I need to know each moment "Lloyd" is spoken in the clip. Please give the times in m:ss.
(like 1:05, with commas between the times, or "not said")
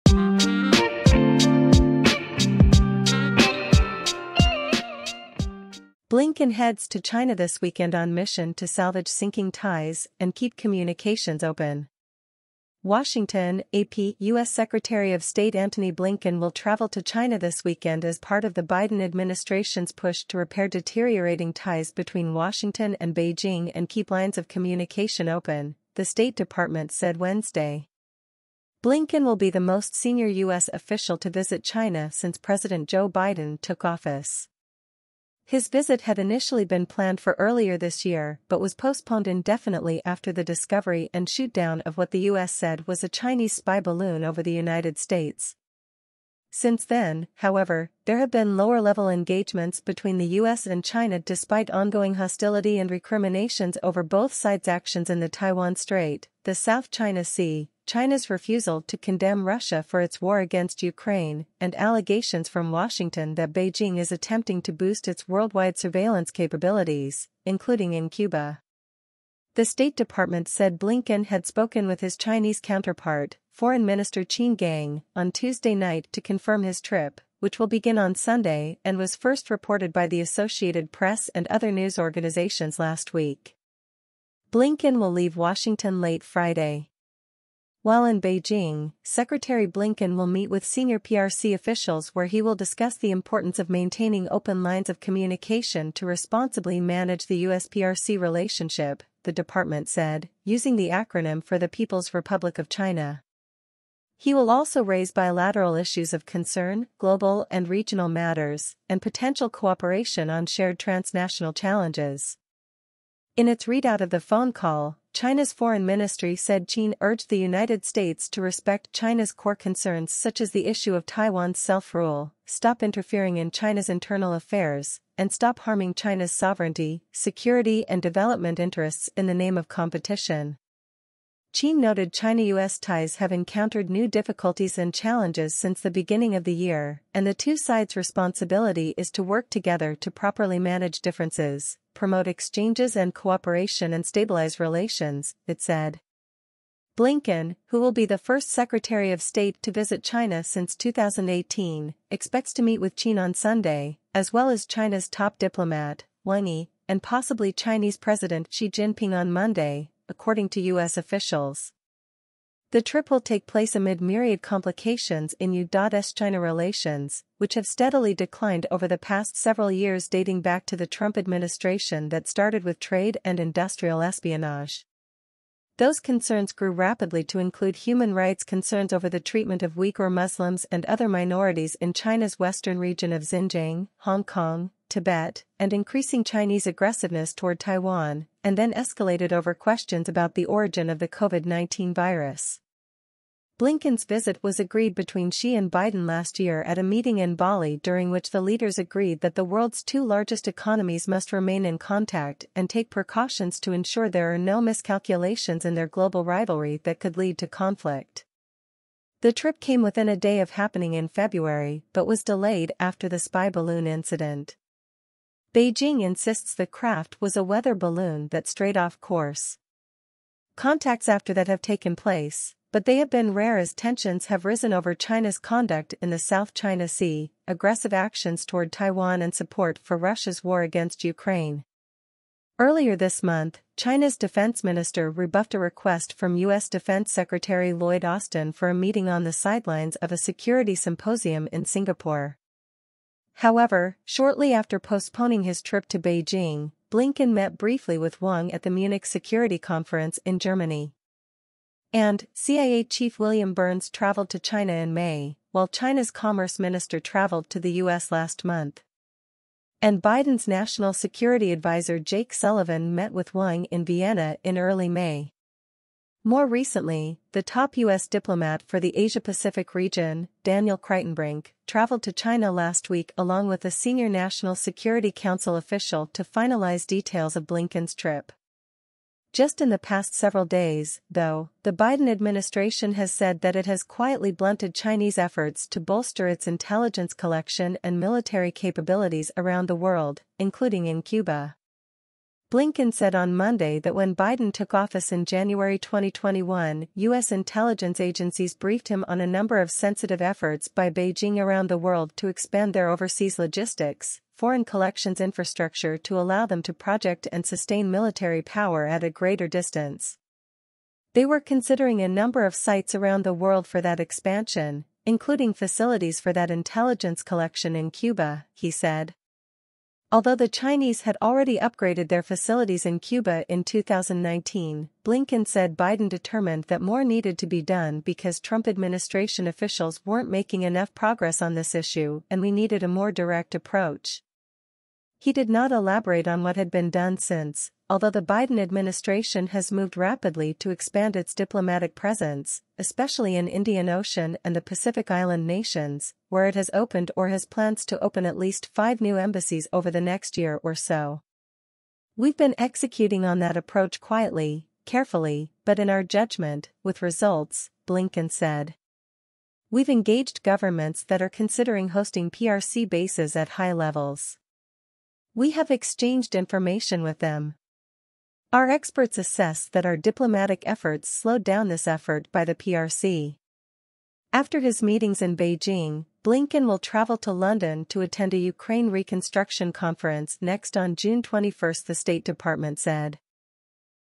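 3:57.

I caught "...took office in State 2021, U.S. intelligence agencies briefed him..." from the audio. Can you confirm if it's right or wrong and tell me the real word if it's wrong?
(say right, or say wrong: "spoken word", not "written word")
wrong: "January", not "State".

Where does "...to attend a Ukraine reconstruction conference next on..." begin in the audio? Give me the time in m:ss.
6:17.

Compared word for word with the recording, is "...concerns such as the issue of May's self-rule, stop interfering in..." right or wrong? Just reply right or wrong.
wrong.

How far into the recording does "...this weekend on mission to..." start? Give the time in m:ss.
0:07.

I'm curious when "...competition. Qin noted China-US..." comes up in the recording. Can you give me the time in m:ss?
2:09.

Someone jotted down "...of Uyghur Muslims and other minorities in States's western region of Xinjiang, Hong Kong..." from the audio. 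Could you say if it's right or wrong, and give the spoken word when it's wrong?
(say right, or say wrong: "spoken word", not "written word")
wrong: "China", not "States".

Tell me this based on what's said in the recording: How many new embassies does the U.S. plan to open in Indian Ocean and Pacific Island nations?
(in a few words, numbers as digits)
5.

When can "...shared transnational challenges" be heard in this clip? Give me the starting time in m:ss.
1:50.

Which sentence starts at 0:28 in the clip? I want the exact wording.
Blinken will be the most senior U.S.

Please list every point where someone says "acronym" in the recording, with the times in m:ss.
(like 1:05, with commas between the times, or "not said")
1:40.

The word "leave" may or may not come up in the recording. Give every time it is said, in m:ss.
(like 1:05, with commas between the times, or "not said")
1:25.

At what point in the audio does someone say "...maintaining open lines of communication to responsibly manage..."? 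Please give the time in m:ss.
1:33.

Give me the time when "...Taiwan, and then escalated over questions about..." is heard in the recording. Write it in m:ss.
3:07.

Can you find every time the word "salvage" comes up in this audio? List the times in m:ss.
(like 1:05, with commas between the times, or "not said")
0:08.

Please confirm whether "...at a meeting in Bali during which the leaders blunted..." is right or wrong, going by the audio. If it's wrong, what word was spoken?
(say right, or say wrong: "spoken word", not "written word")
wrong: "agreed", not "blunted".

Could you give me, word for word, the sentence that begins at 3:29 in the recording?
The trip came within a day of happening in February but was delayed after the spy balloon incident.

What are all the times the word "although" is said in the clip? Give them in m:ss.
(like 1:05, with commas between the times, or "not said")
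5:20, 5:37.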